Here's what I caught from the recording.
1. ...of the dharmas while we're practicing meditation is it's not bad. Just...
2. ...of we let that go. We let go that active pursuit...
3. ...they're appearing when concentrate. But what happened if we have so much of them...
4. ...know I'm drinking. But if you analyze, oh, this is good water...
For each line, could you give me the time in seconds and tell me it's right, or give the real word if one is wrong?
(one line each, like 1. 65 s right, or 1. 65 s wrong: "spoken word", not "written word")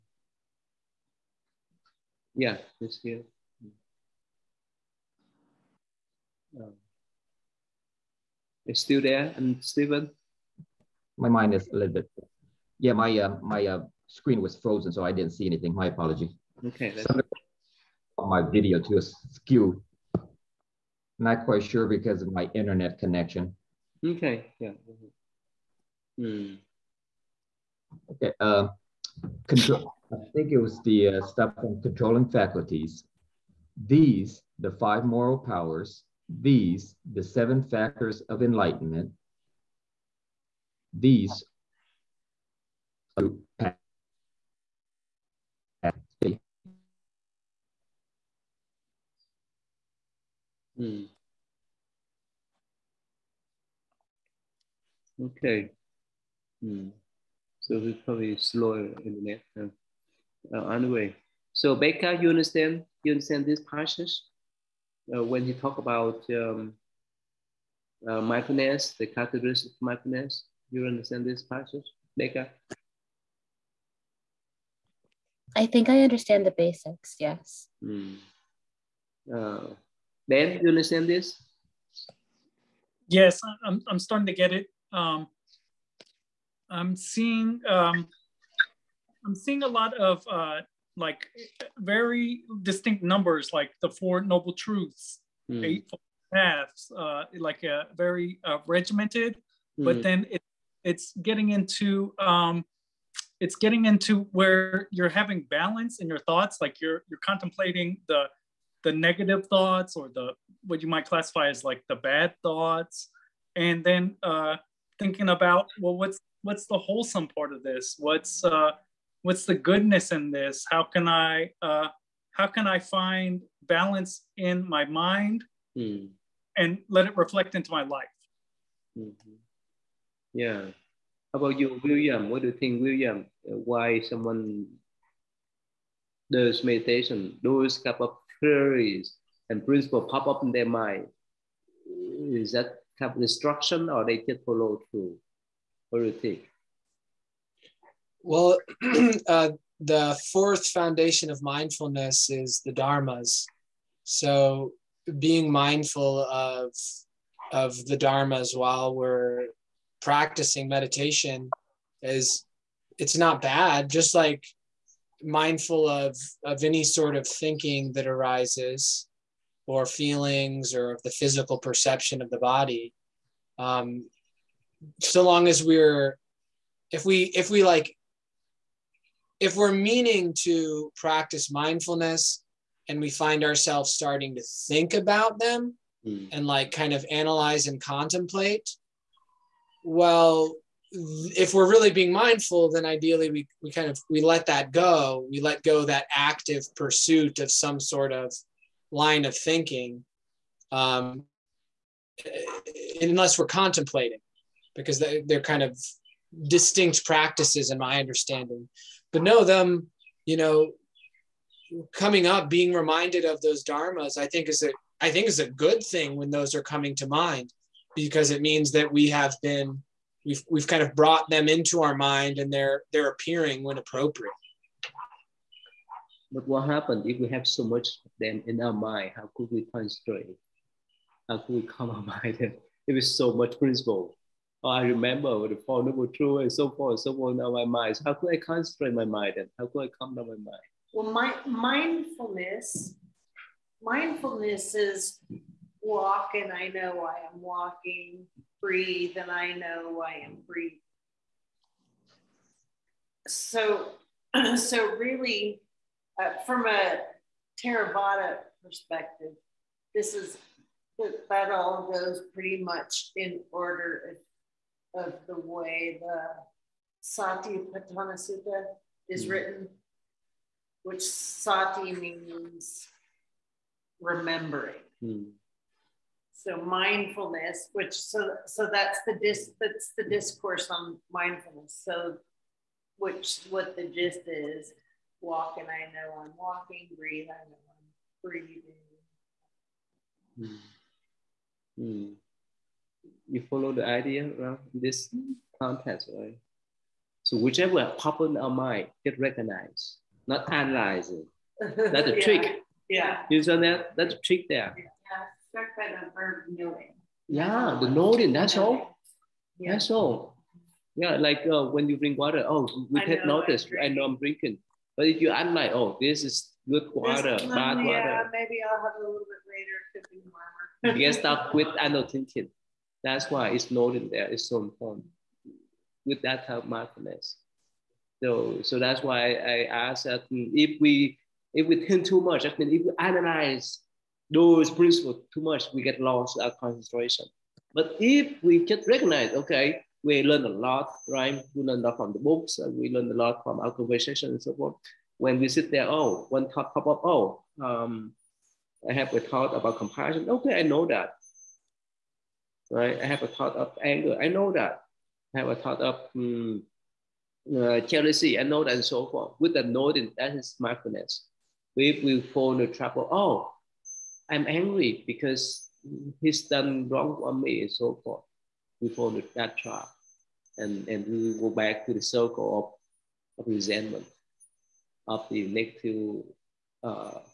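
1. 157 s right
2. 193 s right
3. 222 s wrong: "appropriate", not "concentrate"
4. 313 s right.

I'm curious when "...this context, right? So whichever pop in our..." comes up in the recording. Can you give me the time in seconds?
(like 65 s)
294 s.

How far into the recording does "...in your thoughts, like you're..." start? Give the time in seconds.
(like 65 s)
105 s.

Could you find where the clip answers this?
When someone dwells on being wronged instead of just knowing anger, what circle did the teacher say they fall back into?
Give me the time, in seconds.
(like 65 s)
373 s.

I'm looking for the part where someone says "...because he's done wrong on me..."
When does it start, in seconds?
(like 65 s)
365 s.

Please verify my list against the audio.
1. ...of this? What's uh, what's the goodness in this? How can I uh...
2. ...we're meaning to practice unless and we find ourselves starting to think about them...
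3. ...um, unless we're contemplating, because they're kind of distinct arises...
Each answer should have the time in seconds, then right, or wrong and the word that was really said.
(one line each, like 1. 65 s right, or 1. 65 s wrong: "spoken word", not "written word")
1. 117 s right
2. 179 s wrong: "mindfulness", not "unless"
3. 200 s wrong: "practices", not "arises".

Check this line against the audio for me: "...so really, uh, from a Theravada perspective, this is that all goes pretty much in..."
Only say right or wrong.
right.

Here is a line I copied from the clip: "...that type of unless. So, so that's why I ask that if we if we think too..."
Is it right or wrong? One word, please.
wrong.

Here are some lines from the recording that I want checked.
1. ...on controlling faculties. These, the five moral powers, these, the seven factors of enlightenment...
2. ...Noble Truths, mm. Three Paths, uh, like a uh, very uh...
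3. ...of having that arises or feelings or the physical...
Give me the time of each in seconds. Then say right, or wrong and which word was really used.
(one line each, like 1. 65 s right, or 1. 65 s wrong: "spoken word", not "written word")
1. 31 s right
2. 94 s wrong: "Eight", not "Three"
3. 167 s wrong: "thinking", not "having".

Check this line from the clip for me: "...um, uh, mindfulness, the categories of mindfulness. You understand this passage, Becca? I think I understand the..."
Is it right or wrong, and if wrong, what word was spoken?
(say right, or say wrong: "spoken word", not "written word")
right.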